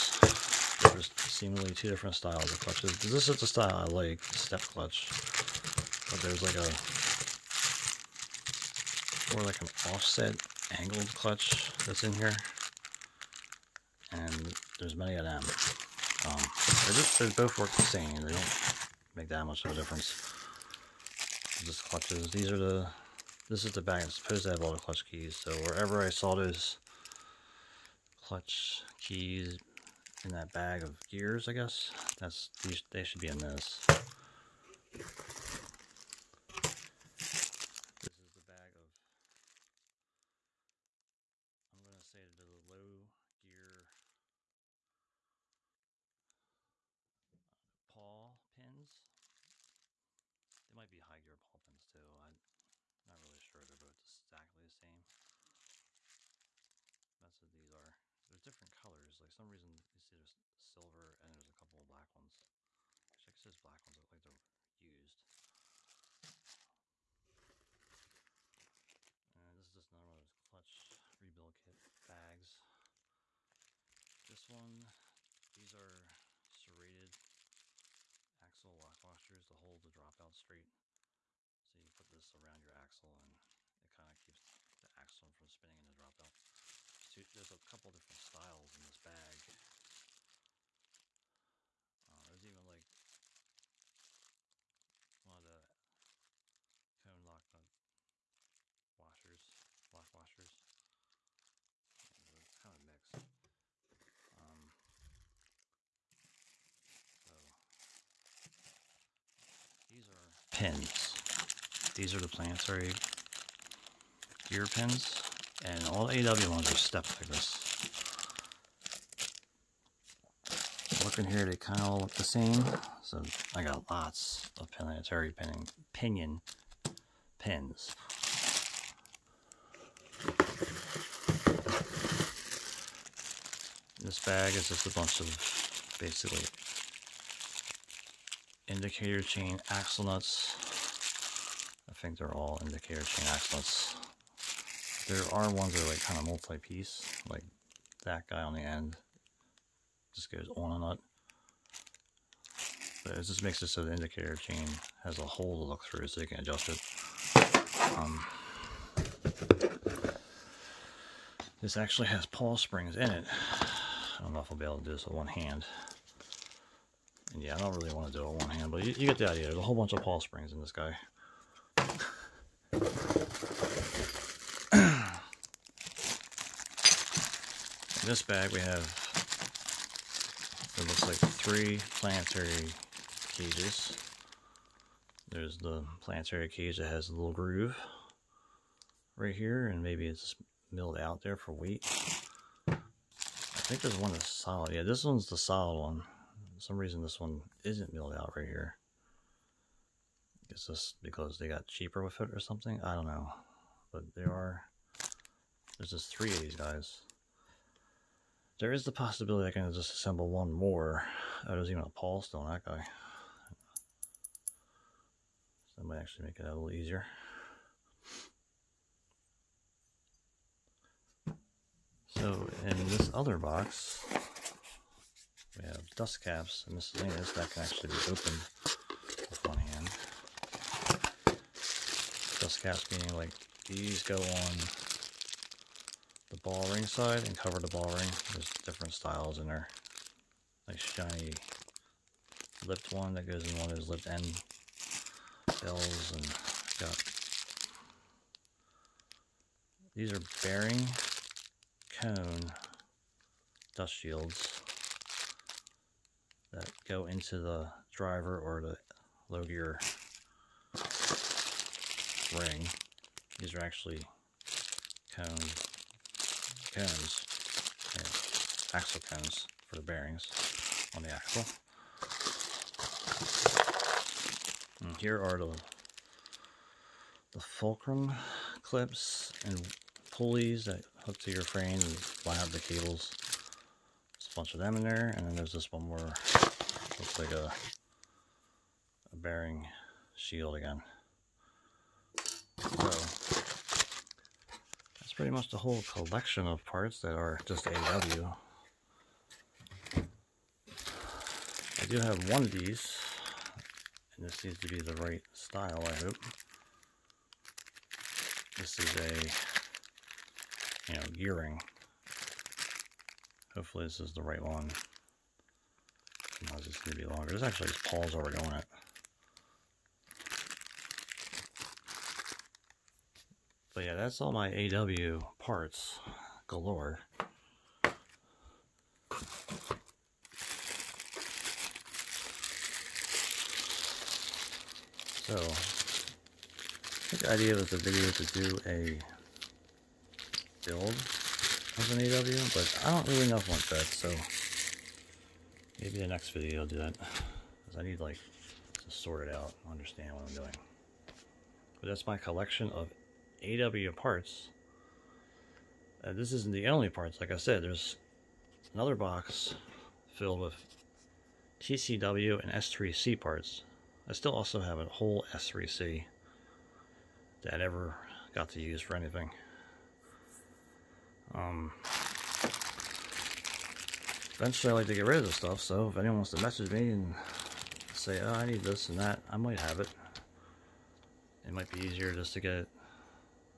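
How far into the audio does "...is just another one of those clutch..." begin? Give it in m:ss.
1:09.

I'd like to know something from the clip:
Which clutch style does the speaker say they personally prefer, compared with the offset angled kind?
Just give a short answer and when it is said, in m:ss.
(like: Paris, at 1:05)
Step clutch, at 0:04.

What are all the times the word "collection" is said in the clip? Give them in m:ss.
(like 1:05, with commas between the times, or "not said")
4:55, 5:52.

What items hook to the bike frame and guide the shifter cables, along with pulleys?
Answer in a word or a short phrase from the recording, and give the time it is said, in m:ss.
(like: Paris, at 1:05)
Fulcrum clips, at 4:37.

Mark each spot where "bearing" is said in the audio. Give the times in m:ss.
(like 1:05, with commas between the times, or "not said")
4:10, 4:29, 4:49.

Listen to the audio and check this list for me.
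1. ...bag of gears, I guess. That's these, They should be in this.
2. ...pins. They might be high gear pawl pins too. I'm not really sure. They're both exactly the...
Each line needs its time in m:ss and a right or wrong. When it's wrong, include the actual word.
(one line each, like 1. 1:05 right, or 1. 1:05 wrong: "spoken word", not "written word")
1. 0:30 right
2. 0:48 right.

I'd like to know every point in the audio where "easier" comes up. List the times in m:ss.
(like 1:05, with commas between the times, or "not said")
3:36, 6:21.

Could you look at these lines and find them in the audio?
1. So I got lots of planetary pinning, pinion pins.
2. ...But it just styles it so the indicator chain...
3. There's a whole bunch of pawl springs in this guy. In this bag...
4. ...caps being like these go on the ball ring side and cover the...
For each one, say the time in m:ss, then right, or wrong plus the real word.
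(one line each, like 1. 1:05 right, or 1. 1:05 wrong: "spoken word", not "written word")
1. 2:03 right
2. 2:33 wrong: "makes", not "styles"
3. 2:49 right
4. 3:52 right.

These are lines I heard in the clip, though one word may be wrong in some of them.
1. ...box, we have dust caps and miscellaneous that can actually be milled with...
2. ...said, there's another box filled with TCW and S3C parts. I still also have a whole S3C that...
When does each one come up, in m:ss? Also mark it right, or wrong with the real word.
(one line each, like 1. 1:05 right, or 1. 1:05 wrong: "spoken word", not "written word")
1. 3:43 wrong: "opened", not "milled"
2. 5:57 right.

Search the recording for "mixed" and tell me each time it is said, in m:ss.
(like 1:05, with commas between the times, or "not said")
1:42.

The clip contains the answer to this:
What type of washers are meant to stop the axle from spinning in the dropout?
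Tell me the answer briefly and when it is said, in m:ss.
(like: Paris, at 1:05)
Serrated axle lock washers, at 1:16.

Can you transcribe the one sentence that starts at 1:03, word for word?
Which I guess there's black ones.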